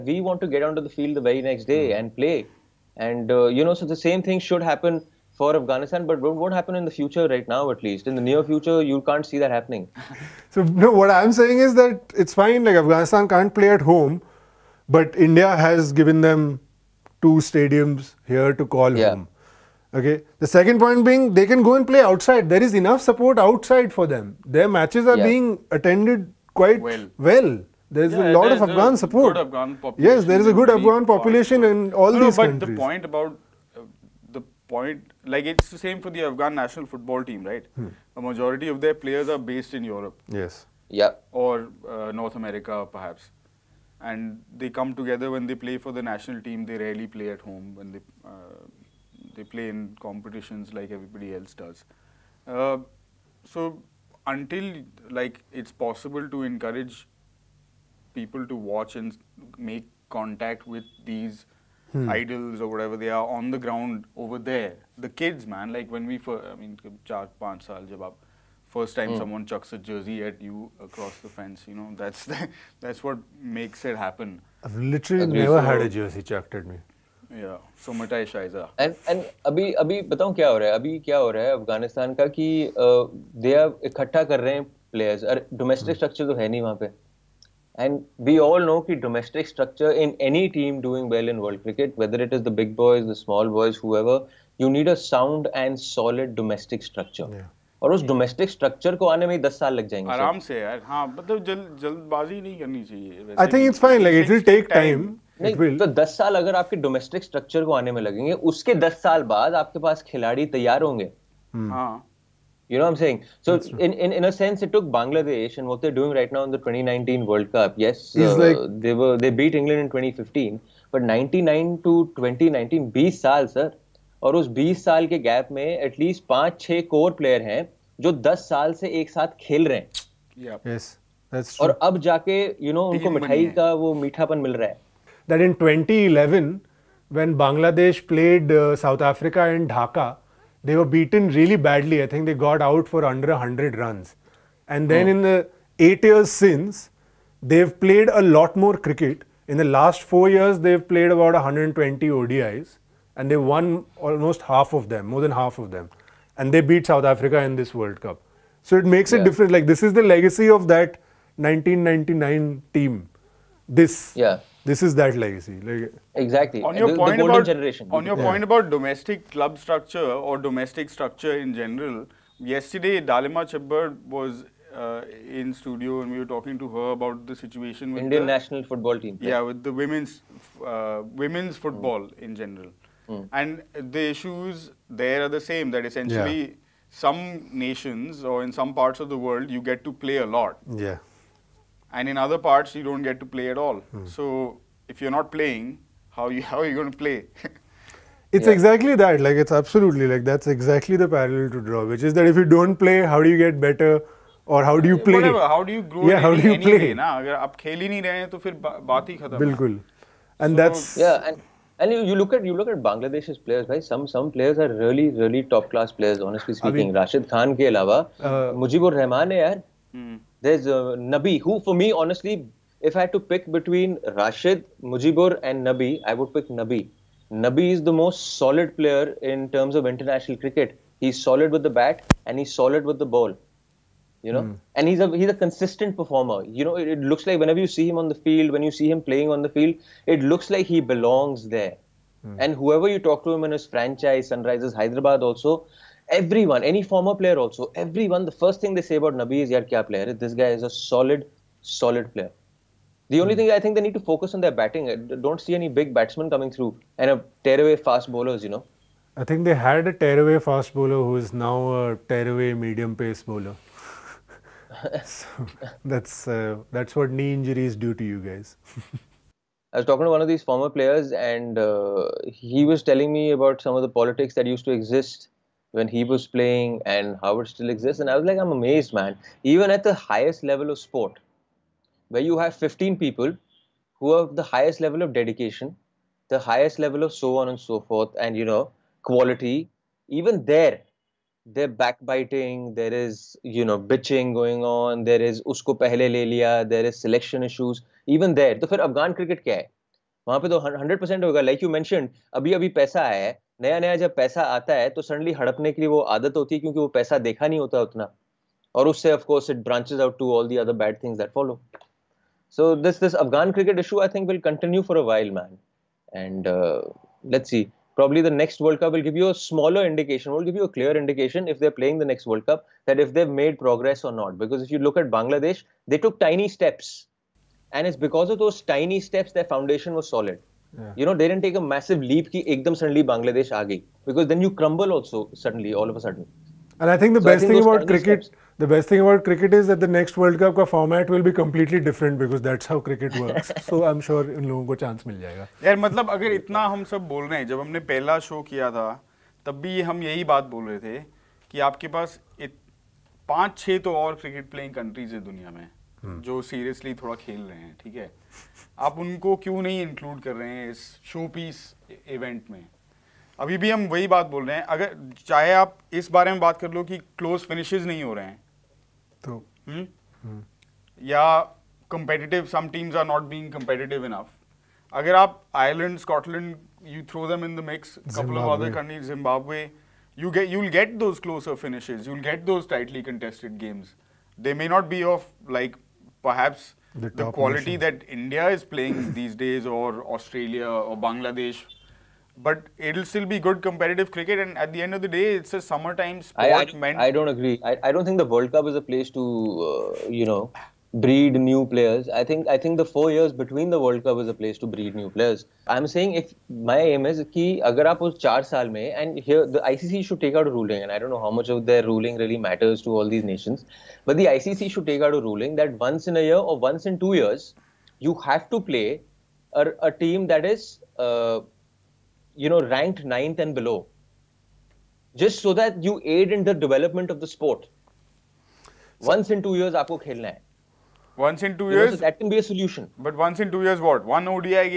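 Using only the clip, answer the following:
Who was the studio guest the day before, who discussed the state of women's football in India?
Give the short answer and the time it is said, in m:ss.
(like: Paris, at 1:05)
Dalima Chhibber, at 2:53.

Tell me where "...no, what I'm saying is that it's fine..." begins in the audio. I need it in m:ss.
0:10.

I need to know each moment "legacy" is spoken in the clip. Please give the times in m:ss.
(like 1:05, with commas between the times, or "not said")
2:40, 2:45.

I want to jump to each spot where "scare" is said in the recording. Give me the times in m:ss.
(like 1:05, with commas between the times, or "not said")
not said.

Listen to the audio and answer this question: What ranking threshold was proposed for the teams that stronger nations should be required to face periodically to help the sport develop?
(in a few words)
ninth and below.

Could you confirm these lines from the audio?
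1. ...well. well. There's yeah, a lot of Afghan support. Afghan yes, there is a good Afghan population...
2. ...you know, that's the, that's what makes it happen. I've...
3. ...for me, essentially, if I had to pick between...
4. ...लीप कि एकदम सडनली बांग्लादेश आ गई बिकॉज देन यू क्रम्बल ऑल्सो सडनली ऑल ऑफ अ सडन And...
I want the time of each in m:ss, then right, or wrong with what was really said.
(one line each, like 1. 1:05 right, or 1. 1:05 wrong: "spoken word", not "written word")
1. 0:26 right
2. 1:11 right
3. 3:41 wrong: "honestly", not "essentially"
4. 5:32 right.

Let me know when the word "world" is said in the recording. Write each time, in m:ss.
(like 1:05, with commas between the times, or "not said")
1:31, 1:57, 2:37, 3:09, 5:40, 6:38, 6:43.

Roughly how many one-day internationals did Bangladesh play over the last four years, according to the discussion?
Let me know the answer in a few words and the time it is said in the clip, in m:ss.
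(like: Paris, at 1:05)
120, at 2:31.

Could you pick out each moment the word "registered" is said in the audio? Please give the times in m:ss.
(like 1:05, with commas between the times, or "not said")
not said.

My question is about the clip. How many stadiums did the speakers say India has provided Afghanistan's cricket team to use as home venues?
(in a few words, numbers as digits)
2.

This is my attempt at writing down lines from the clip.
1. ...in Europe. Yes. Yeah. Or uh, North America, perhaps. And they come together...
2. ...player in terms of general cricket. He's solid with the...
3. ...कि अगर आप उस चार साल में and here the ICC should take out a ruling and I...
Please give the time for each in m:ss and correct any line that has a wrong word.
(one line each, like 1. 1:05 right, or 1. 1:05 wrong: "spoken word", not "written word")
1. 0:39 right
2. 3:48 wrong: "international", not "general"
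3. 6:47 right.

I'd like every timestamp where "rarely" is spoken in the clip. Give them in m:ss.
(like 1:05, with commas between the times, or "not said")
0:46.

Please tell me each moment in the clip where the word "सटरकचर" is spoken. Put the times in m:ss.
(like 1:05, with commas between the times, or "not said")
1:25, 1:38, 1:47.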